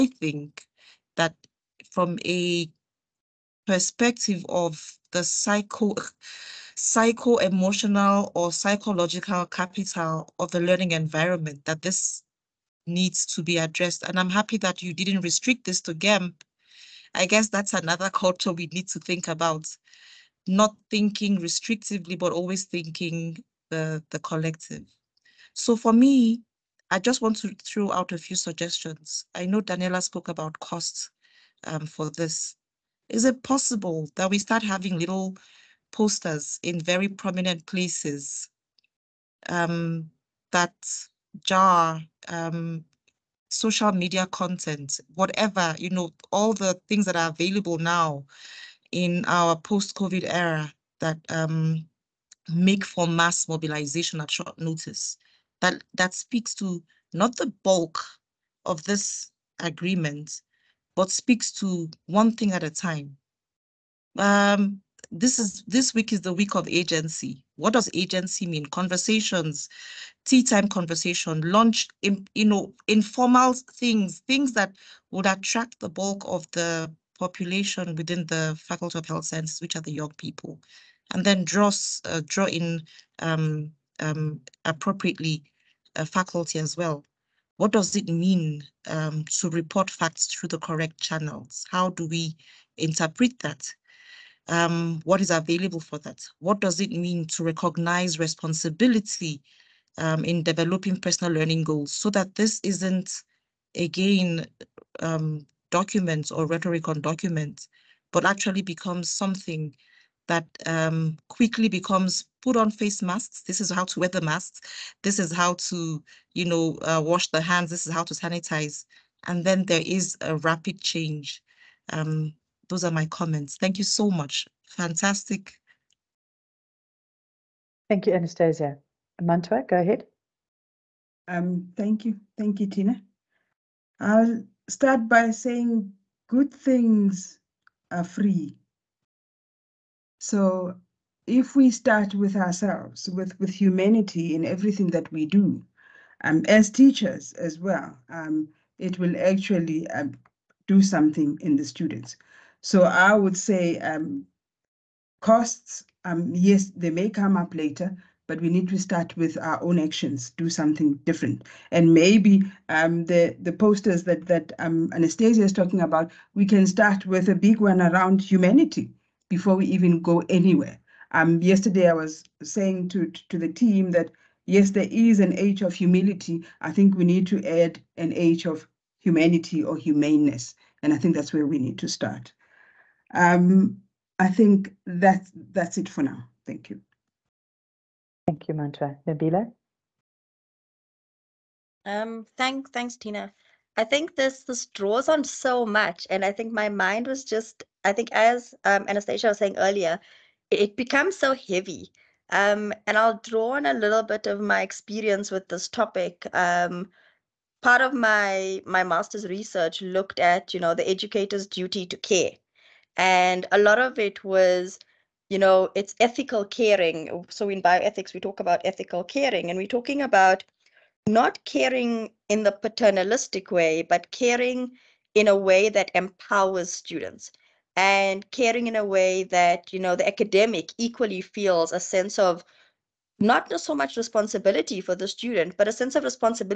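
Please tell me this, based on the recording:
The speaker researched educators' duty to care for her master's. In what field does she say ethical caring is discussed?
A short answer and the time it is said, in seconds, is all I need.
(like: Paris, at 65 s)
bioethics, at 217 s.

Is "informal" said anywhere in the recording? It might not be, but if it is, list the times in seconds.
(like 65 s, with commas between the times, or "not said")
72 s.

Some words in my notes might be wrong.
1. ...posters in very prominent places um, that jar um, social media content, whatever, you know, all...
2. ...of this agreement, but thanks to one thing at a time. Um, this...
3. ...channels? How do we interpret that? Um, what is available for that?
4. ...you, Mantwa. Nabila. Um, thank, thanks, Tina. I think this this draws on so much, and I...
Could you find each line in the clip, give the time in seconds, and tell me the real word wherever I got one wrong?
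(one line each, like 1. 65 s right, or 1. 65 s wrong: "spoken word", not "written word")
1. 35 s right
2. 58 s wrong: "speaks", not "thanks"
3. 90 s right
4. 188 s right.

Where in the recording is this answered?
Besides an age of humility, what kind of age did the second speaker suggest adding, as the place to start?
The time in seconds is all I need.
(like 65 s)
178 s.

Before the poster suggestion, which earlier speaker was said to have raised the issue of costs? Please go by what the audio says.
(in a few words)
Daniela.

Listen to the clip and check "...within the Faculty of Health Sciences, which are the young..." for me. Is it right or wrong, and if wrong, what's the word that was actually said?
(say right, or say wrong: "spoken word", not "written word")
right.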